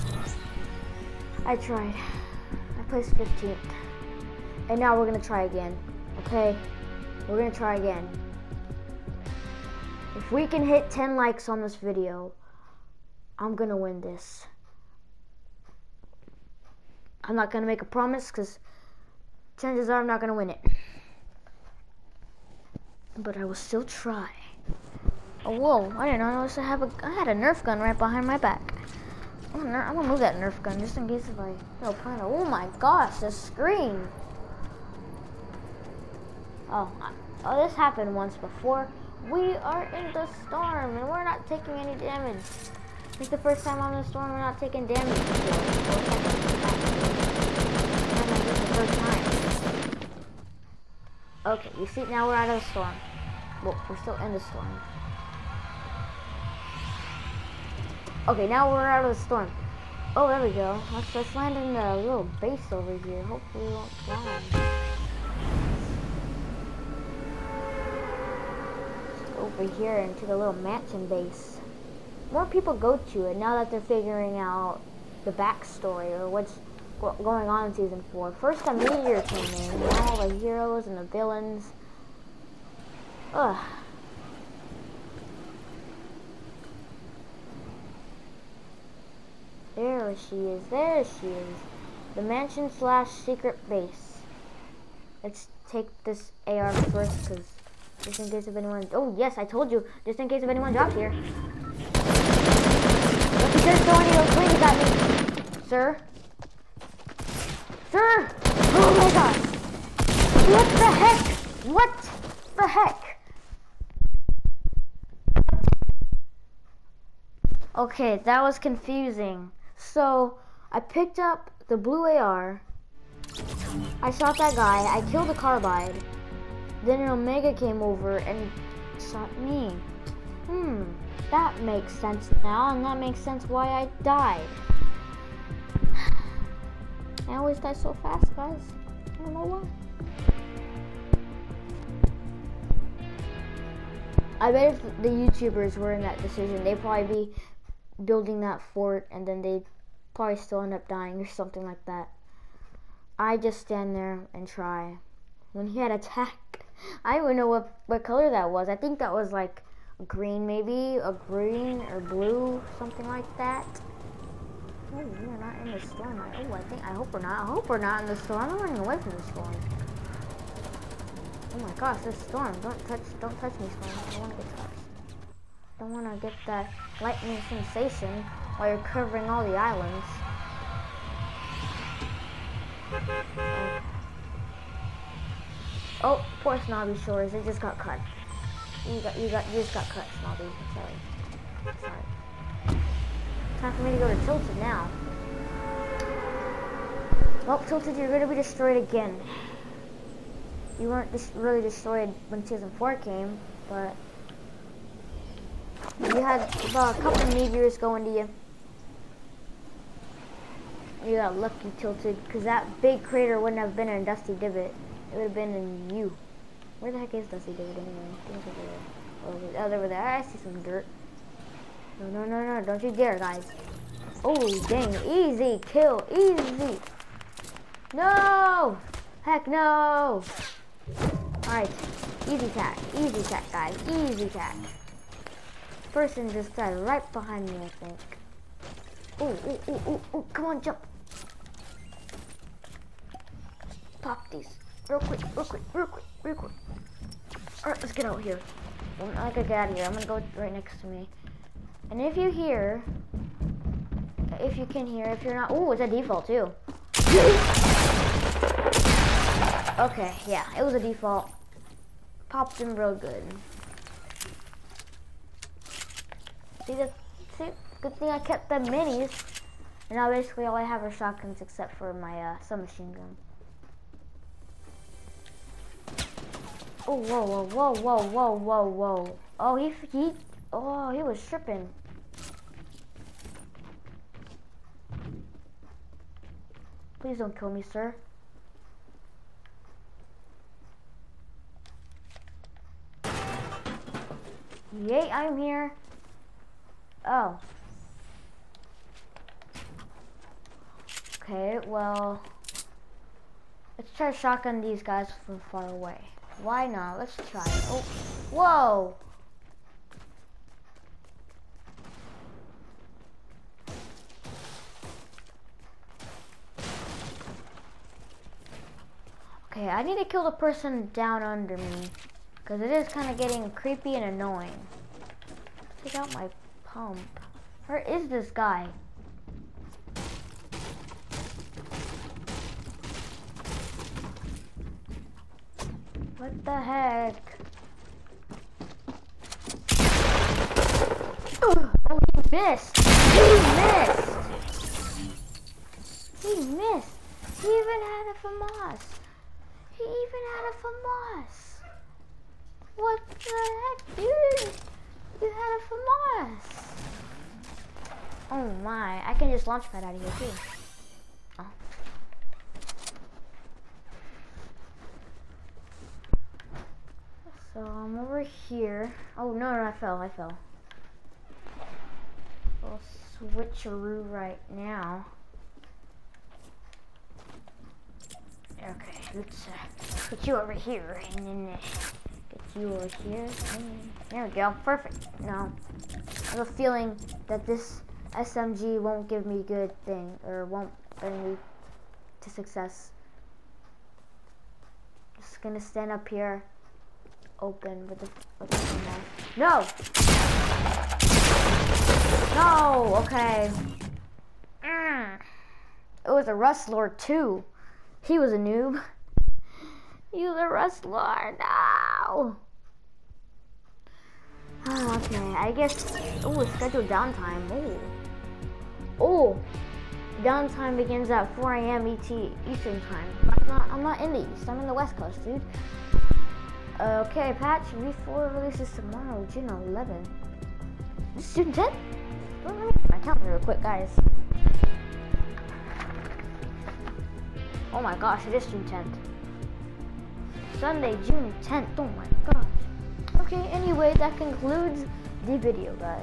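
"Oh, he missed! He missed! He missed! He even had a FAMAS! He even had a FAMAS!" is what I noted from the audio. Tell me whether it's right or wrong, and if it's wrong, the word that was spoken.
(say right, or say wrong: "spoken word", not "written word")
right.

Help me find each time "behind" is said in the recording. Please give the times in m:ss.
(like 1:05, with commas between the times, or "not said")
0:27, 3:57.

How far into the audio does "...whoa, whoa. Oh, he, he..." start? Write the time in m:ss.
4:38.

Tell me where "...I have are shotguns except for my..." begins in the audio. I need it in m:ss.
4:30.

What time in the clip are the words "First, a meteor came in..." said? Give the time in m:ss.
1:18.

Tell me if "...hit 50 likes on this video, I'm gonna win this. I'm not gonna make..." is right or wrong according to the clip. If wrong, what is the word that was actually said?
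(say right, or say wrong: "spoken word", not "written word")
wrong: "10", not "50".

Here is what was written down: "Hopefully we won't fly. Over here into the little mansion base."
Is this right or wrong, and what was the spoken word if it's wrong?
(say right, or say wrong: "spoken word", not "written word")
right.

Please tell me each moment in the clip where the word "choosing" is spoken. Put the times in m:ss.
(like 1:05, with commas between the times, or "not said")
not said.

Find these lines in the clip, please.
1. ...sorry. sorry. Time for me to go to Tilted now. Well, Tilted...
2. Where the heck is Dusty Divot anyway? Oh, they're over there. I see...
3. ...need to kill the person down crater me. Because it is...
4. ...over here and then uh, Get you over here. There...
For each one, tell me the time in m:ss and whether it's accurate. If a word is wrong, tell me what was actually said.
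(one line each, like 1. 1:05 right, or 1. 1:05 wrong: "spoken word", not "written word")
1. 3:10 right
2. 3:36 right
3. 5:19 wrong: "under", not "crater"
4. 6:20 right.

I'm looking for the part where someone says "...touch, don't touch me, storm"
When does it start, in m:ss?
2:52.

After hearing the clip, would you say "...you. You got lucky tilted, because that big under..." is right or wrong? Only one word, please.
wrong.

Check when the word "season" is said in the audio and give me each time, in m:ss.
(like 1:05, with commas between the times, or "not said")
1:17, 3:22.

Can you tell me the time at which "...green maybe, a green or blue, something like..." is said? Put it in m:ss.
2:40.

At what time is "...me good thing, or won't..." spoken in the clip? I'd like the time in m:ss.
6:29.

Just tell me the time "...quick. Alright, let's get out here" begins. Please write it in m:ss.
4:06.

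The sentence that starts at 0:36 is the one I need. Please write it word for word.
Oh, oh, this happened once before.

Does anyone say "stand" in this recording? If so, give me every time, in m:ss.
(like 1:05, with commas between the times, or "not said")
2:33, 6:35.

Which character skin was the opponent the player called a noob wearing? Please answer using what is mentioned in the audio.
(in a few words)
Rust Lord.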